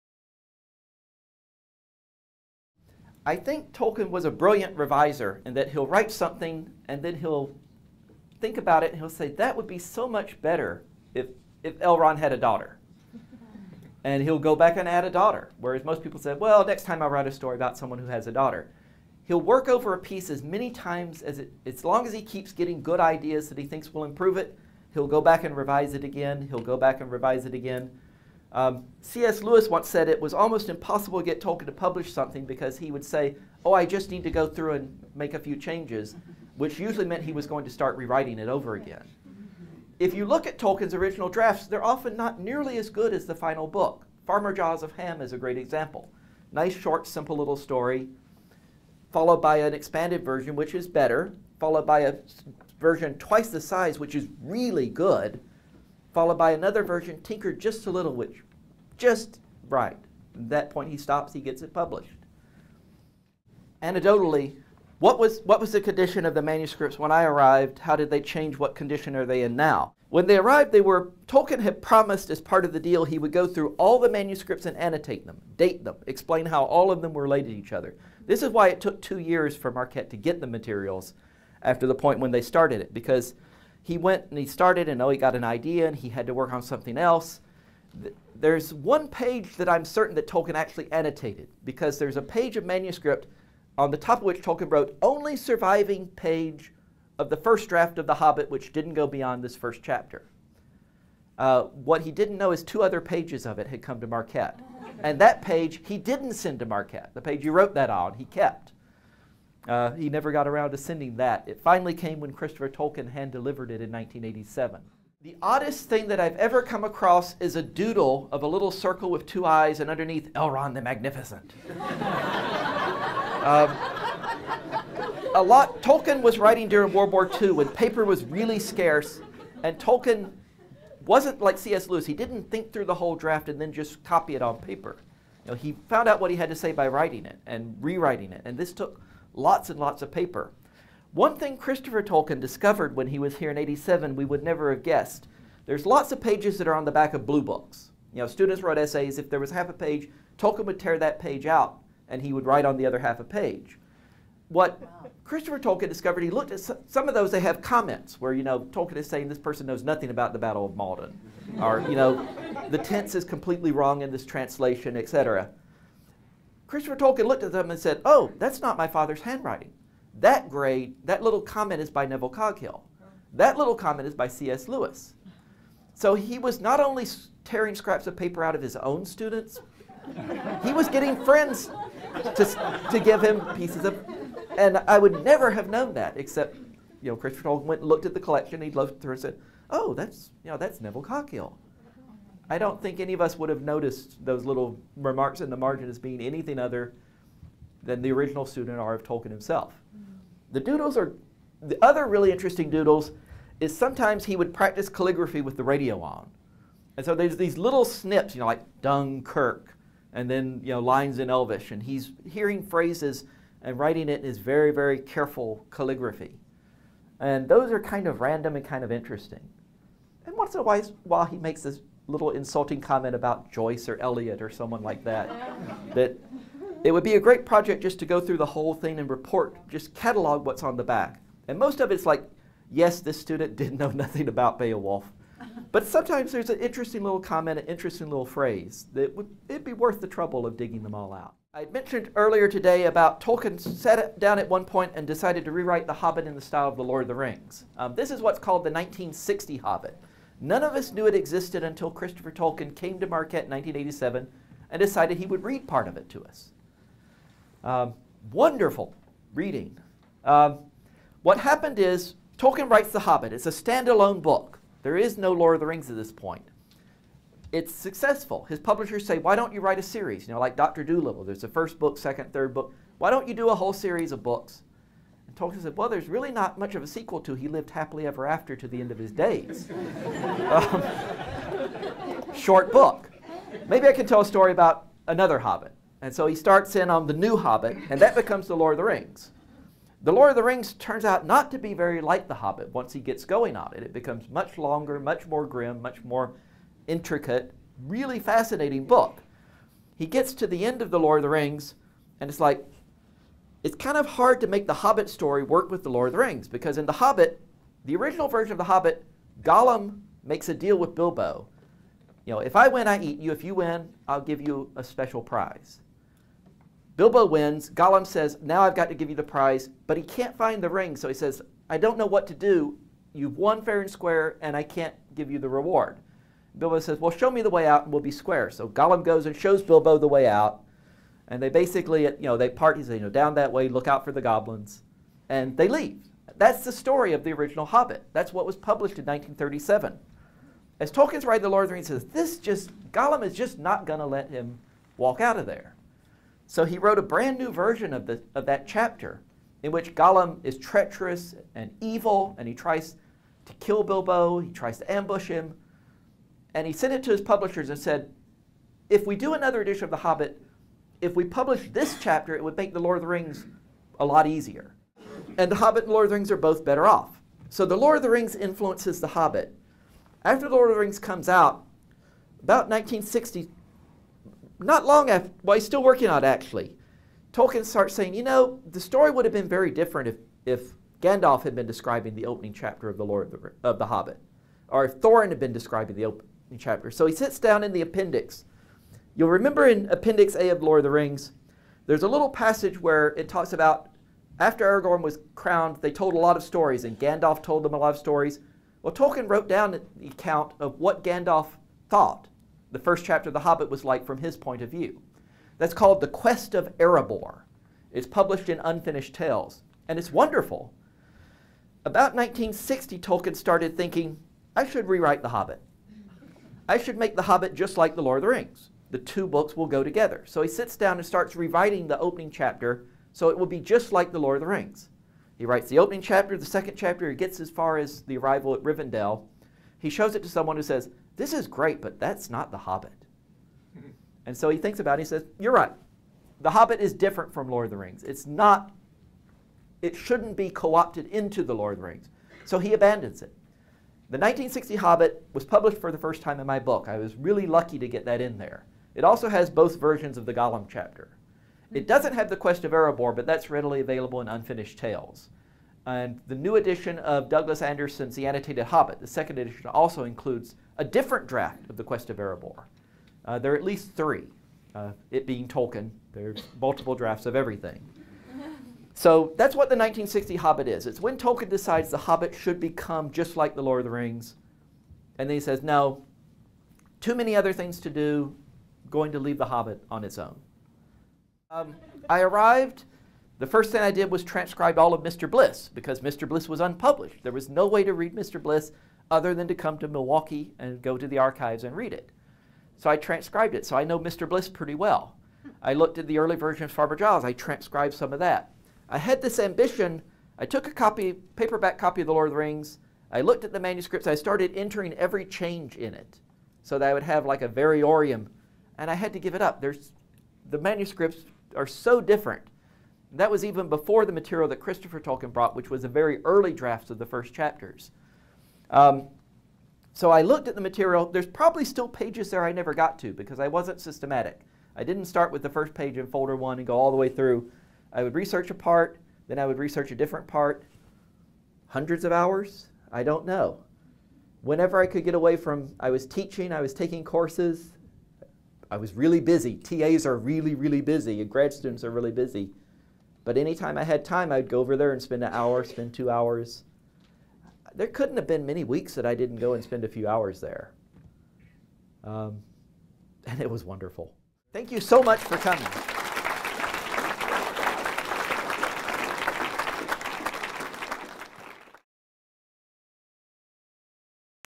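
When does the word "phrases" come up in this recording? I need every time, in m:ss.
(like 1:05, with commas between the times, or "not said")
3:32, 3:58.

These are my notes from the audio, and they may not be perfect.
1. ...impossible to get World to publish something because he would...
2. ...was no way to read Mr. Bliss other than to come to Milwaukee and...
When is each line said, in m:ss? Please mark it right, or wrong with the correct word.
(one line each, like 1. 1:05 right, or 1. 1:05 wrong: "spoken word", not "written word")
1. 0:30 wrong: "Tolkien", not "World"
2. 8:07 right.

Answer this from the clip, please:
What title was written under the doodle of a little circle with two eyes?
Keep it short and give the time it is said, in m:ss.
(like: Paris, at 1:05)
Elrond the Magnificent, at 2:00.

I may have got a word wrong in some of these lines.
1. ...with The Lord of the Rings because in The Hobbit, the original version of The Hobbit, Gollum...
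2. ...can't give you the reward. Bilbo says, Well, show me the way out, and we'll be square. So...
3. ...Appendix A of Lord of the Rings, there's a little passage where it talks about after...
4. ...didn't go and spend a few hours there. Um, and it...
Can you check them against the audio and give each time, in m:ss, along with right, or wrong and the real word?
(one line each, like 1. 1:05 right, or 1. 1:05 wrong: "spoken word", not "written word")
1. 5:05 right
2. 5:24 right
3. 6:29 right
4. 9:09 right.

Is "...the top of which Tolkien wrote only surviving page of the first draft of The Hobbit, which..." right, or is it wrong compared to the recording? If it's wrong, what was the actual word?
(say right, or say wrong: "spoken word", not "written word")
right.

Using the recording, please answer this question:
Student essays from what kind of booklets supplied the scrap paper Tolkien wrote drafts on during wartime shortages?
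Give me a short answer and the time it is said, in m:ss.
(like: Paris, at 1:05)
blue books, at 2:27.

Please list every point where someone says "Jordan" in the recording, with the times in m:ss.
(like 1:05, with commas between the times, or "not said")
not said.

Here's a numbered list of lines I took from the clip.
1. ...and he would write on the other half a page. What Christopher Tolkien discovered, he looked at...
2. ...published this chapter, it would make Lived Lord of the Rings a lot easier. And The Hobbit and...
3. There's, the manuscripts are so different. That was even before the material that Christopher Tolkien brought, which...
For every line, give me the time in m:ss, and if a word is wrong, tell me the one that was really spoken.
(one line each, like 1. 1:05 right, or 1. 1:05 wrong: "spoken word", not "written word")
1. 2:32 right
2. 6:01 wrong: "The", not "Lived"
3. 8:29 right.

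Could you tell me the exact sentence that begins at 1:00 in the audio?
At that point, he stops, he gets it published.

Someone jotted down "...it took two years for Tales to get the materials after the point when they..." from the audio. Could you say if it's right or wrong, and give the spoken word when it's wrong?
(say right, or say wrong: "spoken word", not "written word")
wrong: "Marquette", not "Tales".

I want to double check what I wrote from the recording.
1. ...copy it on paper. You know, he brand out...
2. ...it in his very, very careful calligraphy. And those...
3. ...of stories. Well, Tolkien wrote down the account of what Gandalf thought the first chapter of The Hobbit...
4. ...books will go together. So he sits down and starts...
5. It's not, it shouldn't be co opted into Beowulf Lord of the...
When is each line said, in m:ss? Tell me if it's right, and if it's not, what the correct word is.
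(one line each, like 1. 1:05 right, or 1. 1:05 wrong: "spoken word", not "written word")
1. 2:14 wrong: "found", not "brand"
2. 3:34 right
3. 6:37 right
4. 6:59 right
5. 7:18 wrong: "The", not "Beowulf".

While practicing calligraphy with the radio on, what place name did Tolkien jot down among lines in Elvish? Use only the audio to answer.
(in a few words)
Dunkirk.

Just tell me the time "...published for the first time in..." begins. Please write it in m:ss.
7:25.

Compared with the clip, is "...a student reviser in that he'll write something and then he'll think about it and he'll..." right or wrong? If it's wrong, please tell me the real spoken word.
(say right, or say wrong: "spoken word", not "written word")
wrong: "brilliant", not "student".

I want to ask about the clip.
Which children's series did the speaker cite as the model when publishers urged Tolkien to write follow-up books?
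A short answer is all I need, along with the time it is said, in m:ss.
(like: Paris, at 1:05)
Dr. Dolittle, at 4:30.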